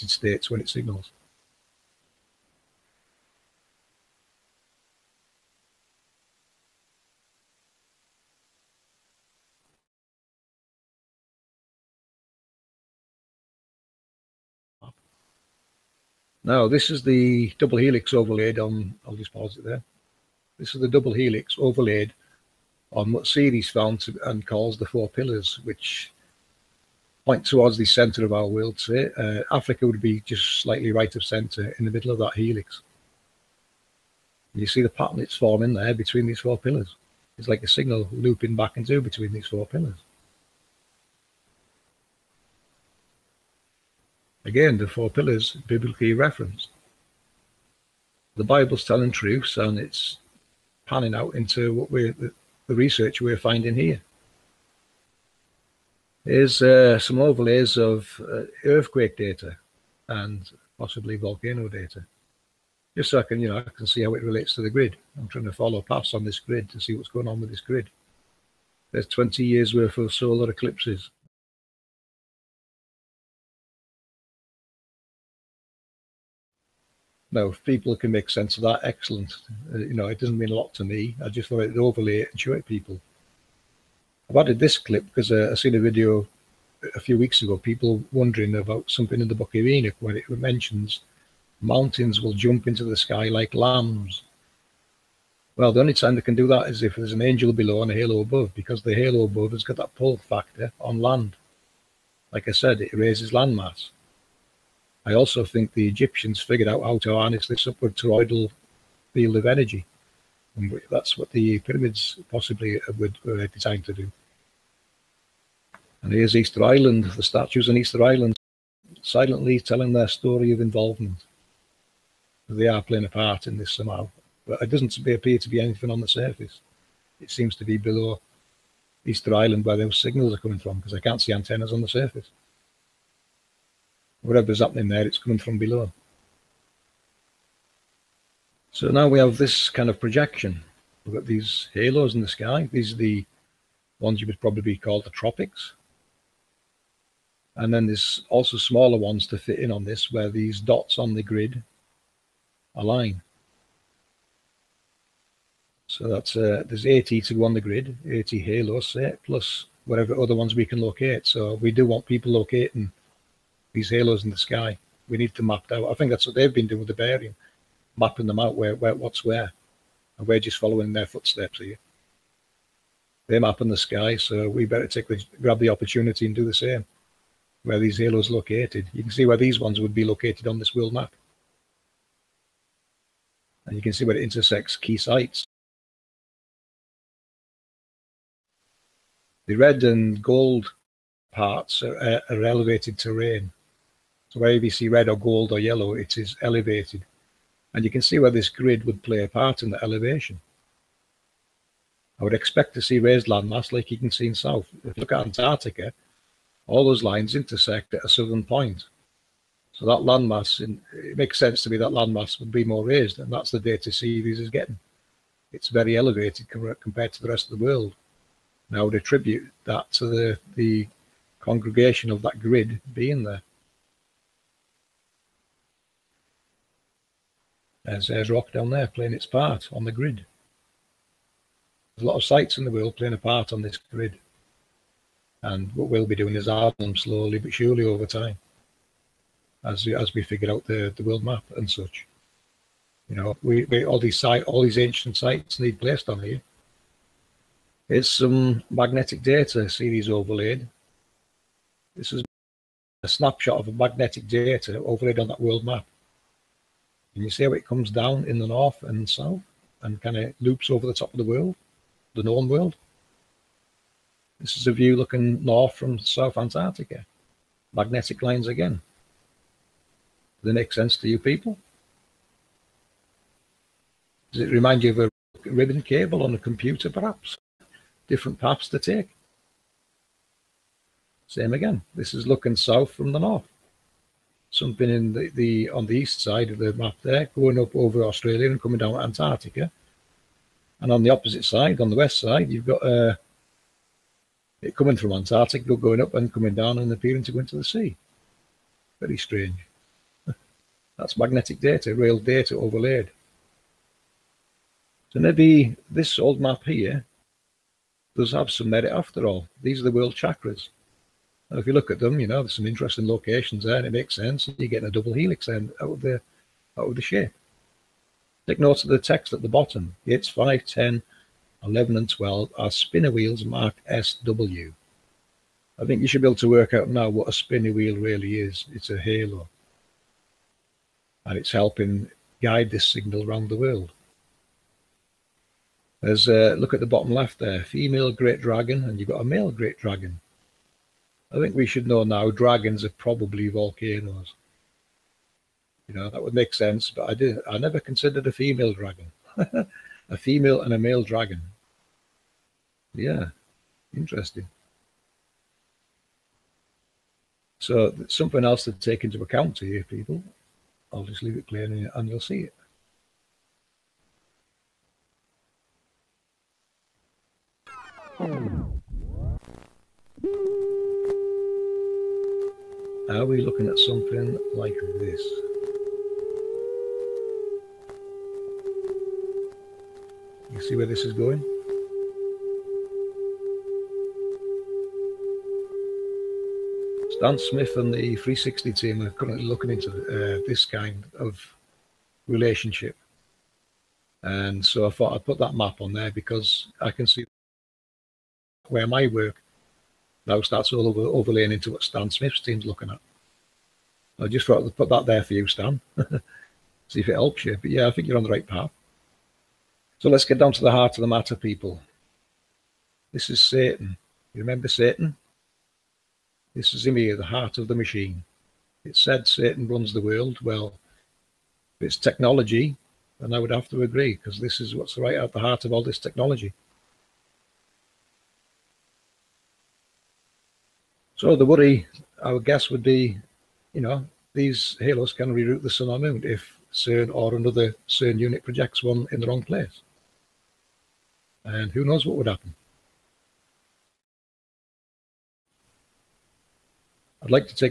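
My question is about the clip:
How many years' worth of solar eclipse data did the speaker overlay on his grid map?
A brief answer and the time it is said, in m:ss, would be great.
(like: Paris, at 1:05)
20, at 1:09.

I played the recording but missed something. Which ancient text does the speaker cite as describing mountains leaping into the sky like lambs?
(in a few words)
Book of Enoch.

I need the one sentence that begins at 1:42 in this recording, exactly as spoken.
Like I said, it raises land mass.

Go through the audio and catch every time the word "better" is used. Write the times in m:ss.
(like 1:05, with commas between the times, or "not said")
2:54.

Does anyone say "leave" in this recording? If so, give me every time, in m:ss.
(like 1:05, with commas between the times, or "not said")
6:01.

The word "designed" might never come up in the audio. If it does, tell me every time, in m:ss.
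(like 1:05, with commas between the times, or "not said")
1:53.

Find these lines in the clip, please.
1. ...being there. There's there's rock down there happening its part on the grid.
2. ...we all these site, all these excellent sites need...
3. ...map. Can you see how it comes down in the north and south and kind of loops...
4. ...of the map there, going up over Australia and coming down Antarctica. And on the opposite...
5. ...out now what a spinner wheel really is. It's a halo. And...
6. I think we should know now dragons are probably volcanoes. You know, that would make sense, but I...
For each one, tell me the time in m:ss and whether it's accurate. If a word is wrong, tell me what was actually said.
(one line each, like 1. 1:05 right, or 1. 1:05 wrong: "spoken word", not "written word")
1. 3:42 wrong: "playing", not "happening"
2. 4:03 wrong: "ancient", not "excellent"
3. 4:15 right
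4. 4:46 right
5. 5:26 right
6. 5:41 right.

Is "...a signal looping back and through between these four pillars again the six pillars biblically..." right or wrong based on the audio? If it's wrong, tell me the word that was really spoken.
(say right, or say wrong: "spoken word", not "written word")
wrong: "four", not "six".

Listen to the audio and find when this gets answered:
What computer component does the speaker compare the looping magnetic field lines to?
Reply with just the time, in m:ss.
4:35.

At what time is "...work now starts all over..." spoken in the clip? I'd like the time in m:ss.
6:39.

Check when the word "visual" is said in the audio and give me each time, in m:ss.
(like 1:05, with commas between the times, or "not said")
not said.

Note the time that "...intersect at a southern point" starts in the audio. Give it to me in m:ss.
3:27.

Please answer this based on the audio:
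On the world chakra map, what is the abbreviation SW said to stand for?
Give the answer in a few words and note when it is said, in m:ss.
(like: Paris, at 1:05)
Spinner wheels, at 5:22.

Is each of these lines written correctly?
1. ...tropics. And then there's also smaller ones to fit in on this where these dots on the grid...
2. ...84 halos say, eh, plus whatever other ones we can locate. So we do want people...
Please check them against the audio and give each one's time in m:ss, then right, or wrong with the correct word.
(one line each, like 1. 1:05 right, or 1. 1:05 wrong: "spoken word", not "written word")
1. 2:25 right
2. 2:38 wrong: "80", not "84".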